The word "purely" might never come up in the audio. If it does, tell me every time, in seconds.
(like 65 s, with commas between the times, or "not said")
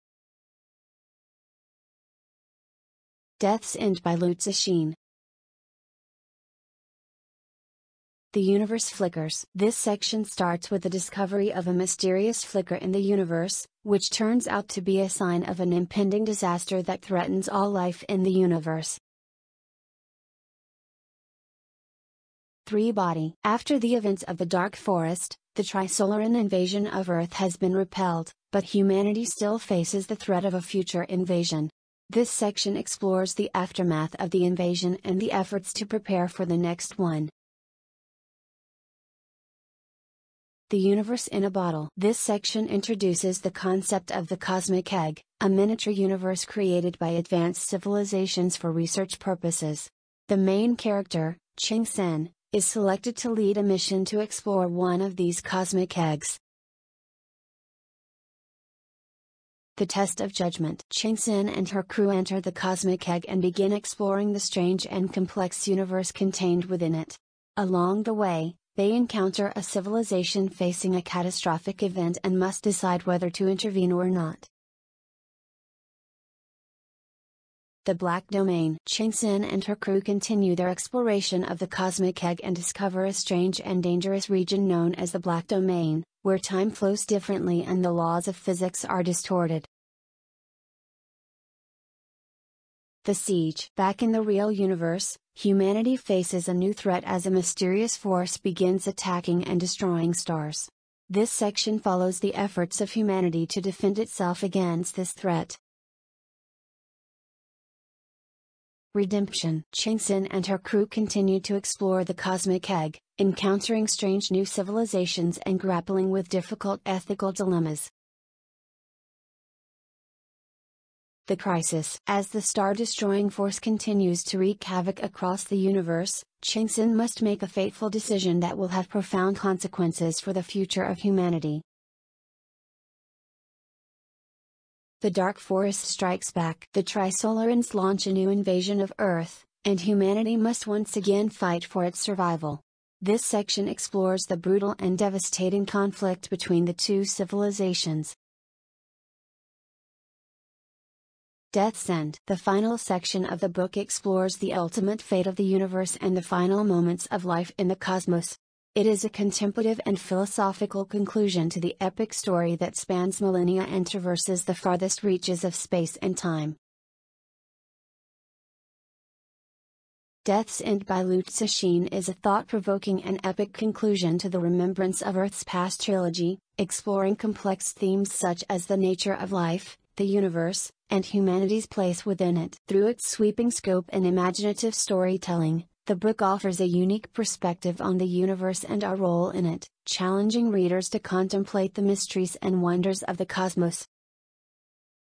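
not said.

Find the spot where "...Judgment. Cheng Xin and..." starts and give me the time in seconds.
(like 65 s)
60 s.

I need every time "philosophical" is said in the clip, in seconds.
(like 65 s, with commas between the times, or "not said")
159 s.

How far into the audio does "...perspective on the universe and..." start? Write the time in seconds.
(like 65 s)
187 s.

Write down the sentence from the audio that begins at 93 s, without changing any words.
The Siege Back in the real universe, humanity faces a new threat as a mysterious force begins attacking and destroying stars.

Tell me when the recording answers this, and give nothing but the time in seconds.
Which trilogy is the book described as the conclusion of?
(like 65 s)
174 s.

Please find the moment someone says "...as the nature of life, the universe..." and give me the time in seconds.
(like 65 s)
178 s.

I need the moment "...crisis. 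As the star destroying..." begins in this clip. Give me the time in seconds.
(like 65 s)
121 s.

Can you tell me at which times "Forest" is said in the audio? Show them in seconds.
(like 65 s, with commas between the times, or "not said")
24 s, 135 s.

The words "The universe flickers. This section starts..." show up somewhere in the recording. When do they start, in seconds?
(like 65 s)
8 s.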